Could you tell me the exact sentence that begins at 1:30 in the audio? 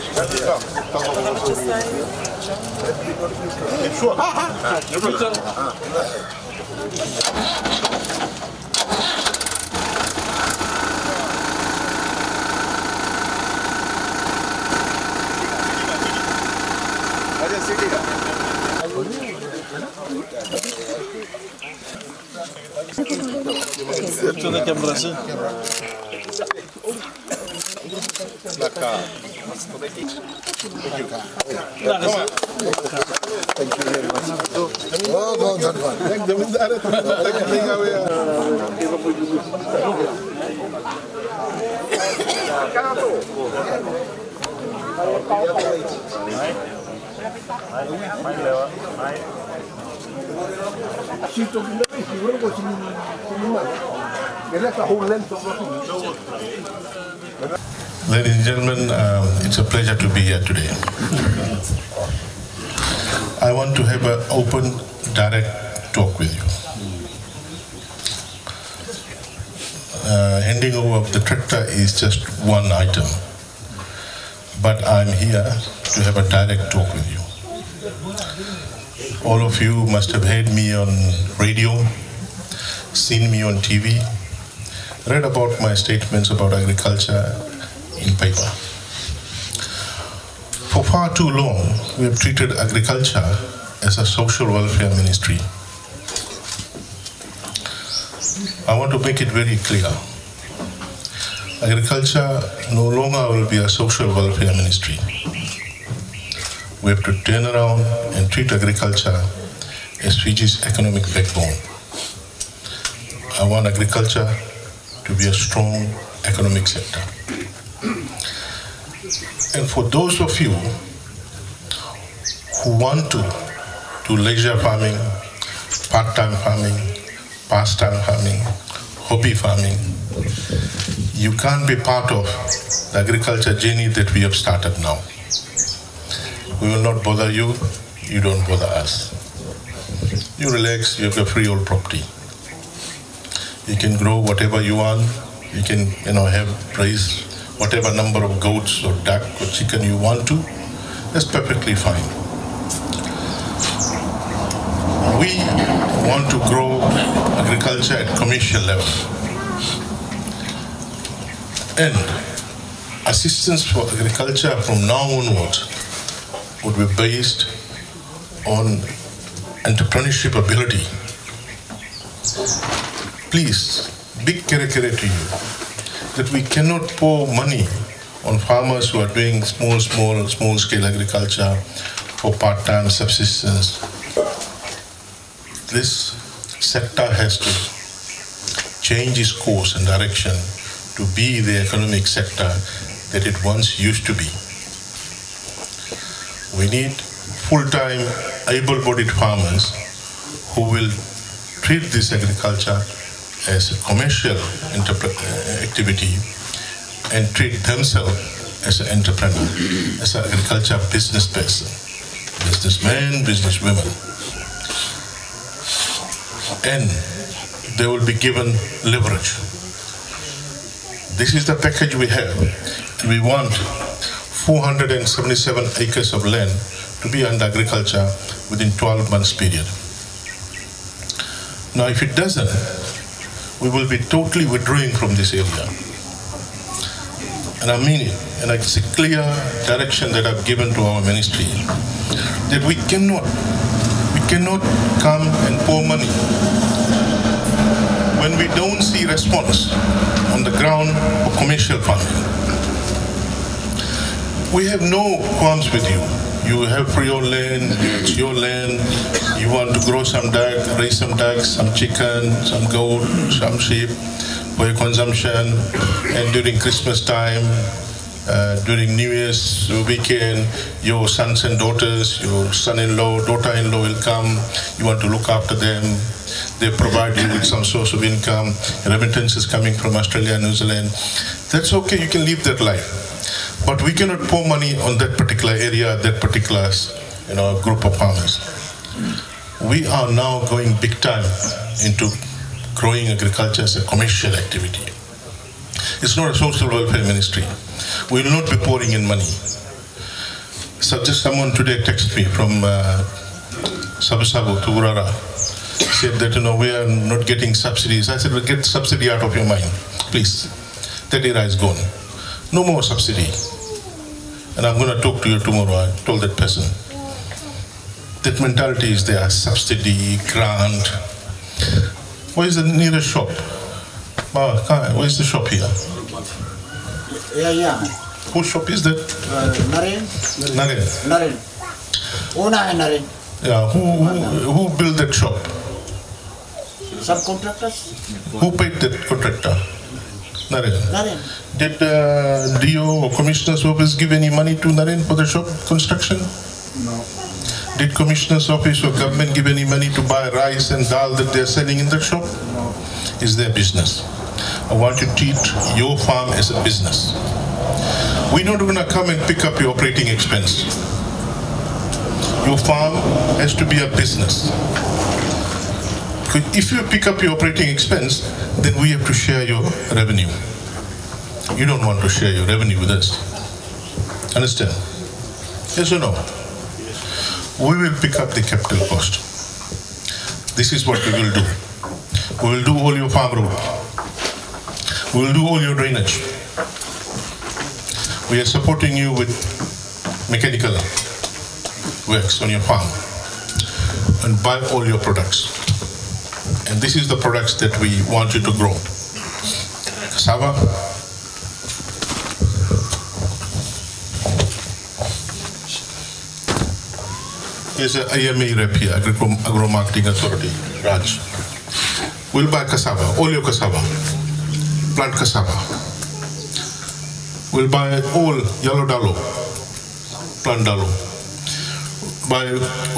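For far too long, we have treated agriculture as a social welfare ministry.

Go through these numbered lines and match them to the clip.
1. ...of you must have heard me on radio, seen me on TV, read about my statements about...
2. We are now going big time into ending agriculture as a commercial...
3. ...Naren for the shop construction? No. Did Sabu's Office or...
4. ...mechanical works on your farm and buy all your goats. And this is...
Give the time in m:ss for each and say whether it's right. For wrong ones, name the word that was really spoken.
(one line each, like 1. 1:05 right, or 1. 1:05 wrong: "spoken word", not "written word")
1. 1:19 right
2. 4:49 wrong: "growing", not "ending"
3. 5:44 wrong: "Commissioner", not "Sabu"
4. 6:30 wrong: "products", not "goats".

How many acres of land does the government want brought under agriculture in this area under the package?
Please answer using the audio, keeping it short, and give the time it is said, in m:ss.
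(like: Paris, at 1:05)
477, at 3:44.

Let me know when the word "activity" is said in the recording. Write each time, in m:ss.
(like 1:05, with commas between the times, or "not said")
3:25, 4:54.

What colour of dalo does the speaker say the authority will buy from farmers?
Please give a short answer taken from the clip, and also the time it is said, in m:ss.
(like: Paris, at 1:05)
yellow, at 6:58.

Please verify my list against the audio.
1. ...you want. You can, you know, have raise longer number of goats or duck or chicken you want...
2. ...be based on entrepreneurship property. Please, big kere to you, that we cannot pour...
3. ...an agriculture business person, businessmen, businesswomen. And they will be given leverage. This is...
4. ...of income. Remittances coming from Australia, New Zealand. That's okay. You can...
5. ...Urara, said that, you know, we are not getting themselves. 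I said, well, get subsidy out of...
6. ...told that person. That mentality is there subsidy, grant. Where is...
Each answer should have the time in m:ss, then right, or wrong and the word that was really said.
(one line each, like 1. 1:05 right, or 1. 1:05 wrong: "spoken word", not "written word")
1. 2:24 wrong: "whatever", not "longer"
2. 2:46 wrong: "ability", not "property"
3. 3:30 right
4. 4:37 right
5. 5:04 wrong: "subsidies", not "themselves"
6. 5:16 right.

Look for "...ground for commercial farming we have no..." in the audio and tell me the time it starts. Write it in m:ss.
4:10.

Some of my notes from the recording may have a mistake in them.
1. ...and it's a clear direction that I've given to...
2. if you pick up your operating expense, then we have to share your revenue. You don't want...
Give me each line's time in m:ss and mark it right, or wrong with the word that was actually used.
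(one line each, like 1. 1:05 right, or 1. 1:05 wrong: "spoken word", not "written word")
1. 3:58 right
2. 6:06 right.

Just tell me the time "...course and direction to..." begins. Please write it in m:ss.
3:09.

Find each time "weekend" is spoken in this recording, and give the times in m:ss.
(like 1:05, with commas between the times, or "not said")
4:29.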